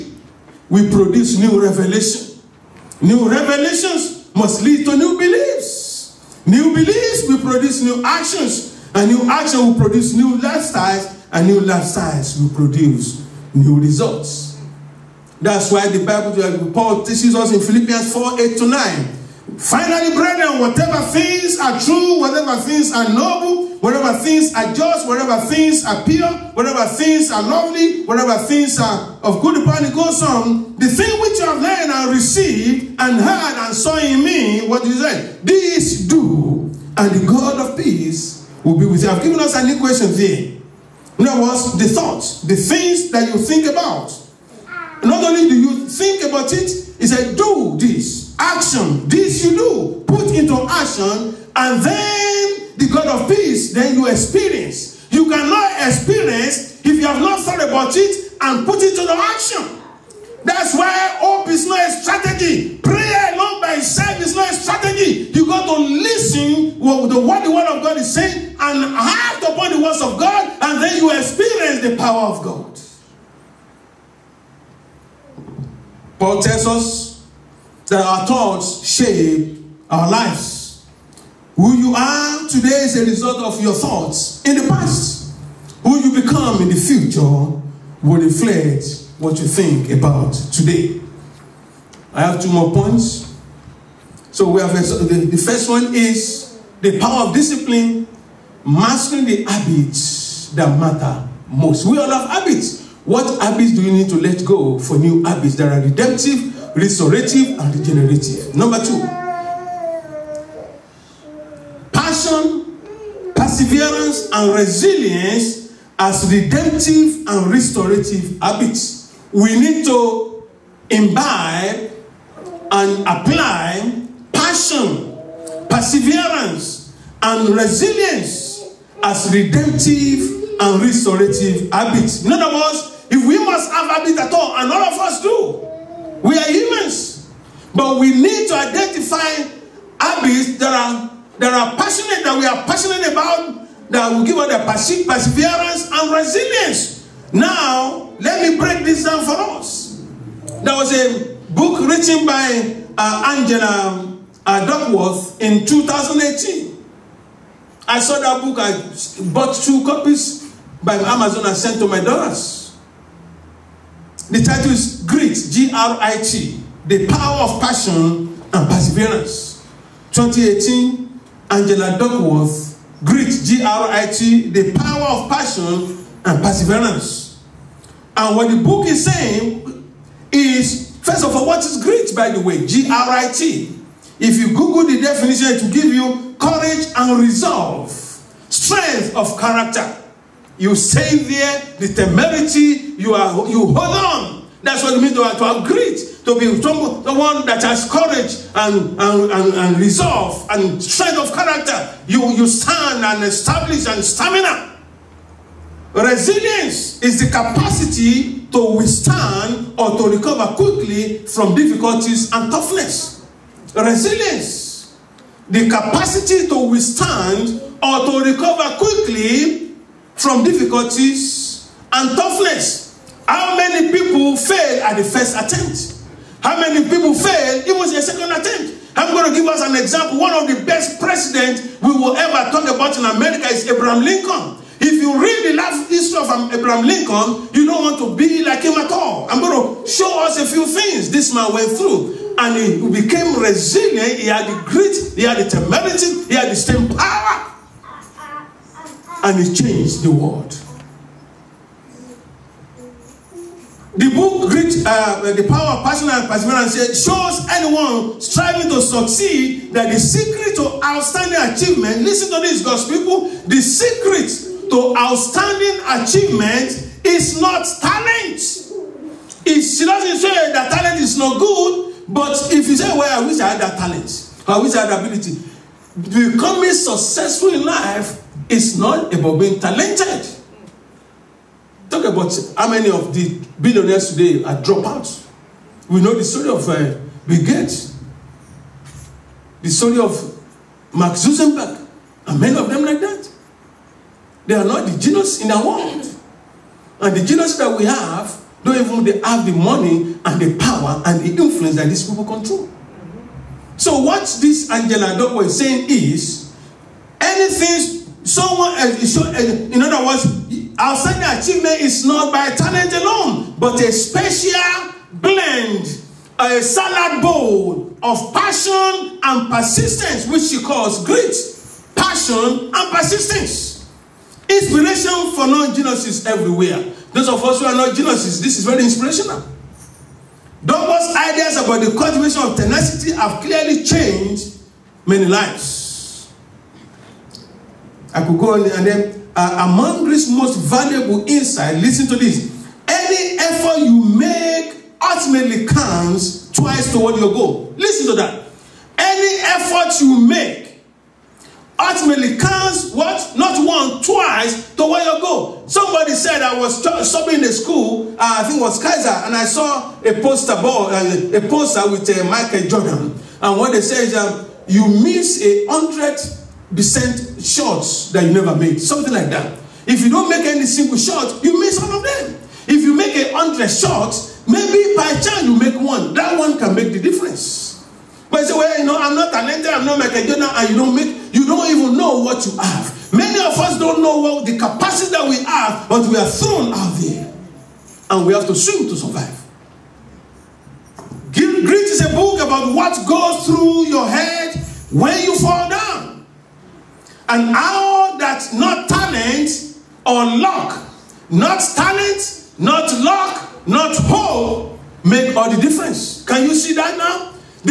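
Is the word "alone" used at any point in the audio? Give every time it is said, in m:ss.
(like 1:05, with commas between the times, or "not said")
1:03, 5:12.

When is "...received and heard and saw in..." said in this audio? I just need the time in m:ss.
0:32.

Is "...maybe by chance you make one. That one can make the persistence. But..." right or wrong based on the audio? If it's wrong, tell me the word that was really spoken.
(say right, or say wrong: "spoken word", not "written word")
wrong: "difference", not "persistence".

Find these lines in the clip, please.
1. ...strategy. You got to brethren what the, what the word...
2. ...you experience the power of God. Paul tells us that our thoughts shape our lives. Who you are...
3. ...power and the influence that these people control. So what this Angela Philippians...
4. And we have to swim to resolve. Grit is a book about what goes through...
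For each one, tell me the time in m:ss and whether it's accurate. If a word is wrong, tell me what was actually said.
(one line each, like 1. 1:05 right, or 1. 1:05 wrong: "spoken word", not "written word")
1. 1:04 wrong: "listen", not "brethren"
2. 1:10 right
3. 5:00 wrong: "Doko", not "Philippians"
4. 6:28 wrong: "survive", not "resolve".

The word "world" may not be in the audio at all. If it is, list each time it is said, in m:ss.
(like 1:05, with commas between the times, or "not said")
4:10, 4:55.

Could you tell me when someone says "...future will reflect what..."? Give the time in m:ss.
1:26.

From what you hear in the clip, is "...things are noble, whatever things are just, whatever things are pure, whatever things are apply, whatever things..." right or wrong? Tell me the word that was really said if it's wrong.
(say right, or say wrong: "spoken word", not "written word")
wrong: "lovely", not "apply".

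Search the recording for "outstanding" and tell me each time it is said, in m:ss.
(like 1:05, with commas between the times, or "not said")
4:20, 4:24.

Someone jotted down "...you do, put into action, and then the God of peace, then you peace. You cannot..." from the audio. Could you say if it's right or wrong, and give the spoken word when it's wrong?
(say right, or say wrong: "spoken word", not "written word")
wrong: "experience", not "peace".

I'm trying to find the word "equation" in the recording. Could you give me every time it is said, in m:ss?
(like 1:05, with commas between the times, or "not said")
0:39.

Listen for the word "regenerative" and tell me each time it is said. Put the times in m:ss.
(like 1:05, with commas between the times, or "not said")
1:47.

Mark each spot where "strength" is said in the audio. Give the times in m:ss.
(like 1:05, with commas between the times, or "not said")
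3:08, 3:20.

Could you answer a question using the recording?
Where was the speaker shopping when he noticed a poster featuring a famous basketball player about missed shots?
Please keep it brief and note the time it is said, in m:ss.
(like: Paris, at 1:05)
Kaiser, at 5:58.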